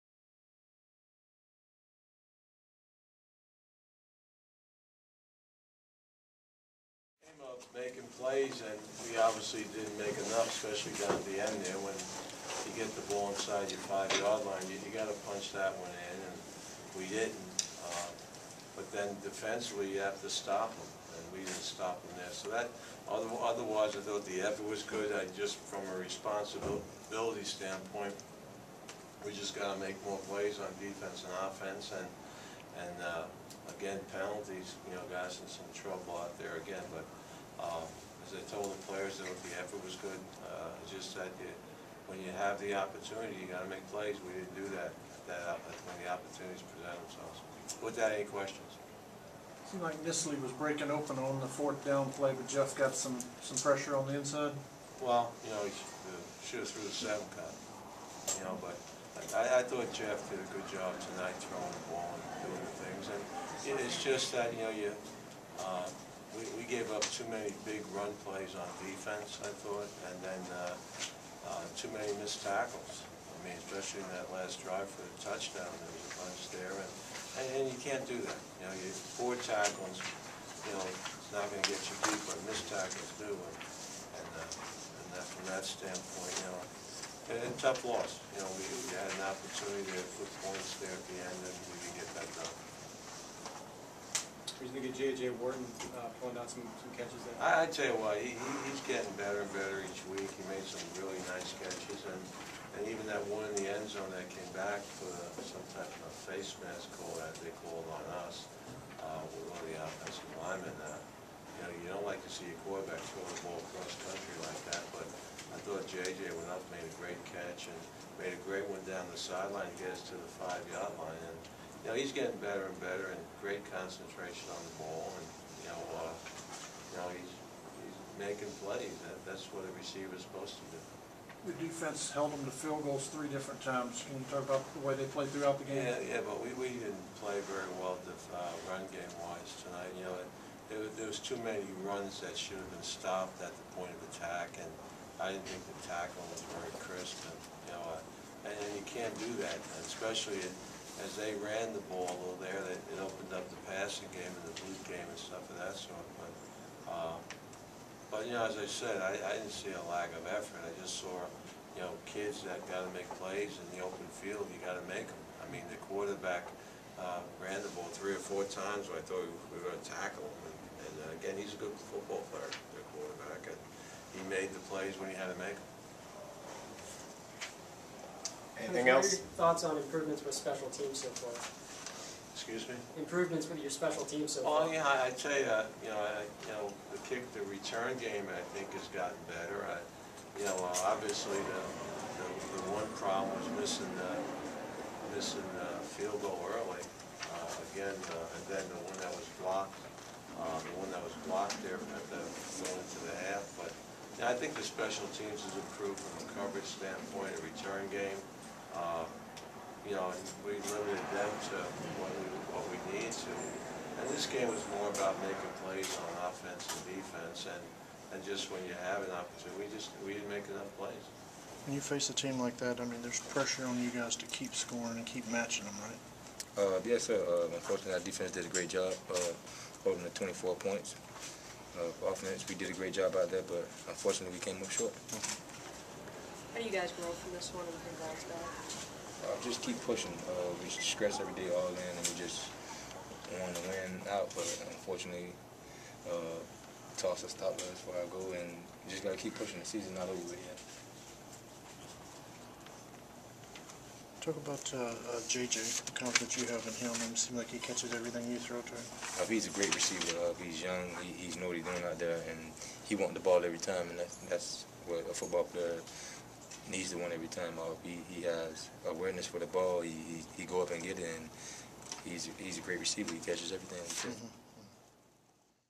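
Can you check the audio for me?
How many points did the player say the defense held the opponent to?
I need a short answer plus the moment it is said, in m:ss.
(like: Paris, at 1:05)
24, at 3:50.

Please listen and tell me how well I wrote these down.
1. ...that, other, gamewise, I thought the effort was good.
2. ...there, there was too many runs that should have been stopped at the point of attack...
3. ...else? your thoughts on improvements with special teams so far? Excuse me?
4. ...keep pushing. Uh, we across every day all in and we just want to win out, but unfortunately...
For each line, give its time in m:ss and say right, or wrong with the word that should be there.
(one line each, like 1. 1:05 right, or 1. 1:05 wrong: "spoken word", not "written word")
1. 0:22 wrong: "otherwise", not "gamewise"
2. 2:20 right
3. 2:59 right
4. 3:59 wrong: "stress", not "across".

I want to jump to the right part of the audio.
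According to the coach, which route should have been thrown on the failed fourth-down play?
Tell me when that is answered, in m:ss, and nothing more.
0:56.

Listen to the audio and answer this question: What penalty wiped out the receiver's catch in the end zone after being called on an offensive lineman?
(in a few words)
face mask.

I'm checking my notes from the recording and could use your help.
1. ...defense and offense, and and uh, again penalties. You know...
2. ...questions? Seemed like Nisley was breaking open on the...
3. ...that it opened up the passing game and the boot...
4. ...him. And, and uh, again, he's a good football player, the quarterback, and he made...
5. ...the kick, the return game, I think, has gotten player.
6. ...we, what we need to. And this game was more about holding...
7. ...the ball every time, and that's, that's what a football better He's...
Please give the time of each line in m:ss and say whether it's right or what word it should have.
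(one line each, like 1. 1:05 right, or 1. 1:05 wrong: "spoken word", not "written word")
1. 0:30 right
2. 0:48 right
3. 2:32 right
4. 2:50 right
5. 3:06 wrong: "better", not "player"
6. 3:32 wrong: "making", not "holding"
7. 4:23 wrong: "player", not "better".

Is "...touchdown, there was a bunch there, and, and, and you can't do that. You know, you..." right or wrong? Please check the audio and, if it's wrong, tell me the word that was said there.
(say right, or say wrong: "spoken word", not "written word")
right.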